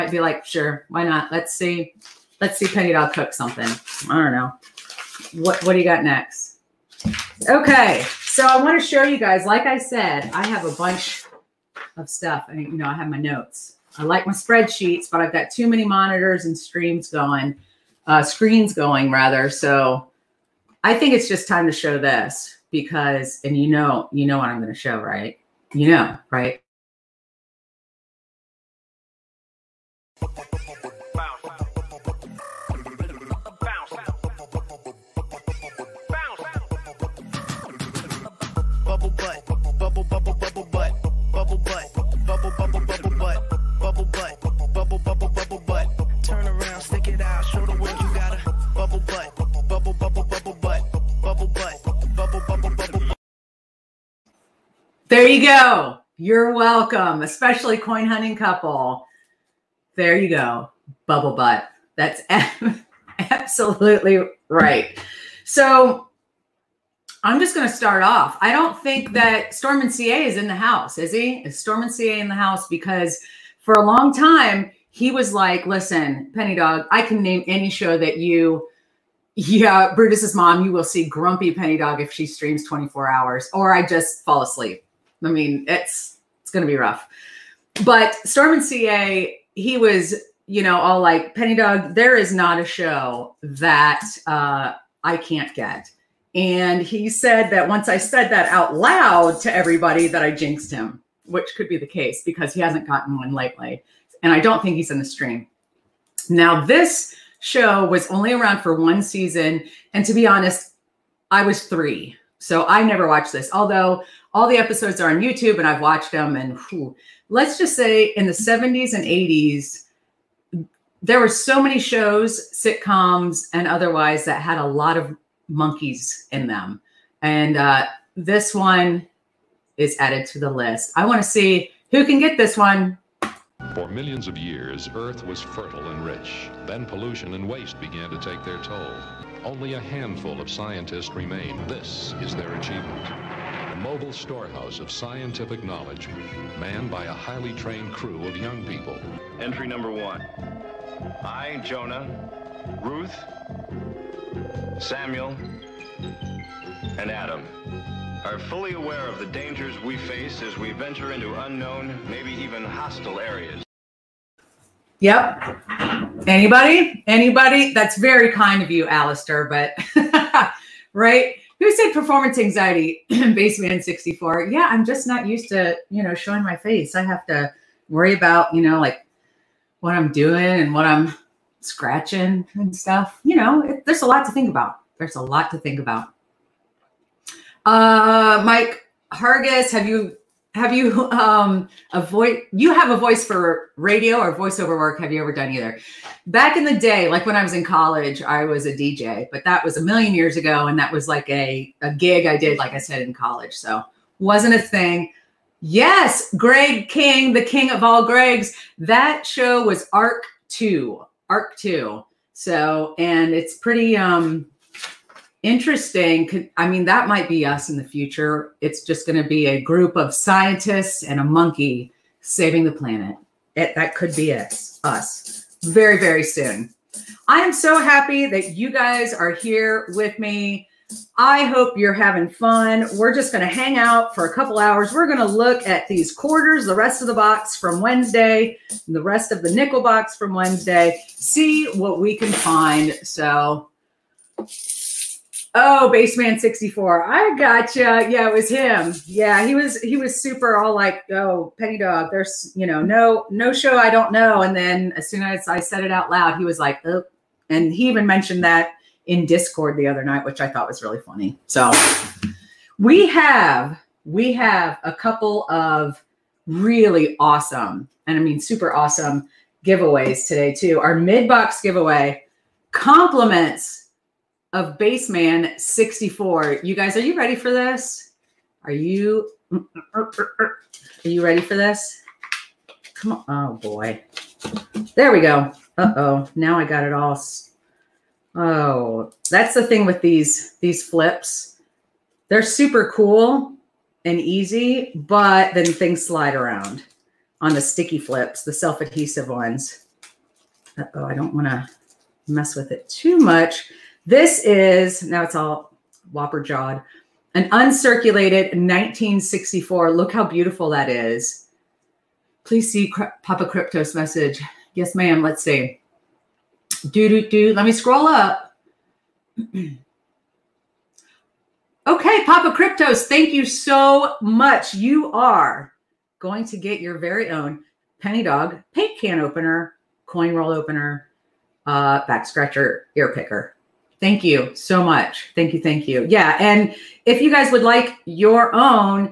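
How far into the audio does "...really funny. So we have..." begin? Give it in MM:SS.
04:20.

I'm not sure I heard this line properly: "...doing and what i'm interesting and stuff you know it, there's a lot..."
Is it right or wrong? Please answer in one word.
wrong.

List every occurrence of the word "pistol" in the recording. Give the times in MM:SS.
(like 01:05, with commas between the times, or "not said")
not said.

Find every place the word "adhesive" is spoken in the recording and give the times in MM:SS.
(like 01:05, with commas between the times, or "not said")
04:58.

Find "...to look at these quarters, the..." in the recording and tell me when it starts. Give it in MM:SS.
03:55.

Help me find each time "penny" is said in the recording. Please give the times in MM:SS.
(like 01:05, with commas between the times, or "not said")
00:02, 01:16, 01:21, 01:31, 04:11, 05:28.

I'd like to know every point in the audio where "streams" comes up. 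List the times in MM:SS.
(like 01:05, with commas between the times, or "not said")
00:16, 01:22, 01:45.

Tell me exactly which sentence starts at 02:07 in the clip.
And uh, this one is added to the list.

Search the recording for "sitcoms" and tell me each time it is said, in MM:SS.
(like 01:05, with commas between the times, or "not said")
02:02.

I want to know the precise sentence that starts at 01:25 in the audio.
I mean, it's it's gonna be rough.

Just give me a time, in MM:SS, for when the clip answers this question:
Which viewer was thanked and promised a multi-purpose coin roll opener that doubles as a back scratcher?
05:22.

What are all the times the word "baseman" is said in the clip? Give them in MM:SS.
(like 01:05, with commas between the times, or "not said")
02:53, 04:05, 04:34.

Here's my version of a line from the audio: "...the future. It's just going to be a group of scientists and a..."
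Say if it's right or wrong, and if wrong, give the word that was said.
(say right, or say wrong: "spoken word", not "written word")
right.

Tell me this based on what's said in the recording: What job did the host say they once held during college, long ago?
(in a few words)
DJ.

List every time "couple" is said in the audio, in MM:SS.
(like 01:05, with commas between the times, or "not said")
00:58, 03:54, 04:24.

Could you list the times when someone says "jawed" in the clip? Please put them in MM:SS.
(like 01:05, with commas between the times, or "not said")
05:06.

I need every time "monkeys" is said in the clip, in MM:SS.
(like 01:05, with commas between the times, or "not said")
02:05, 03:41.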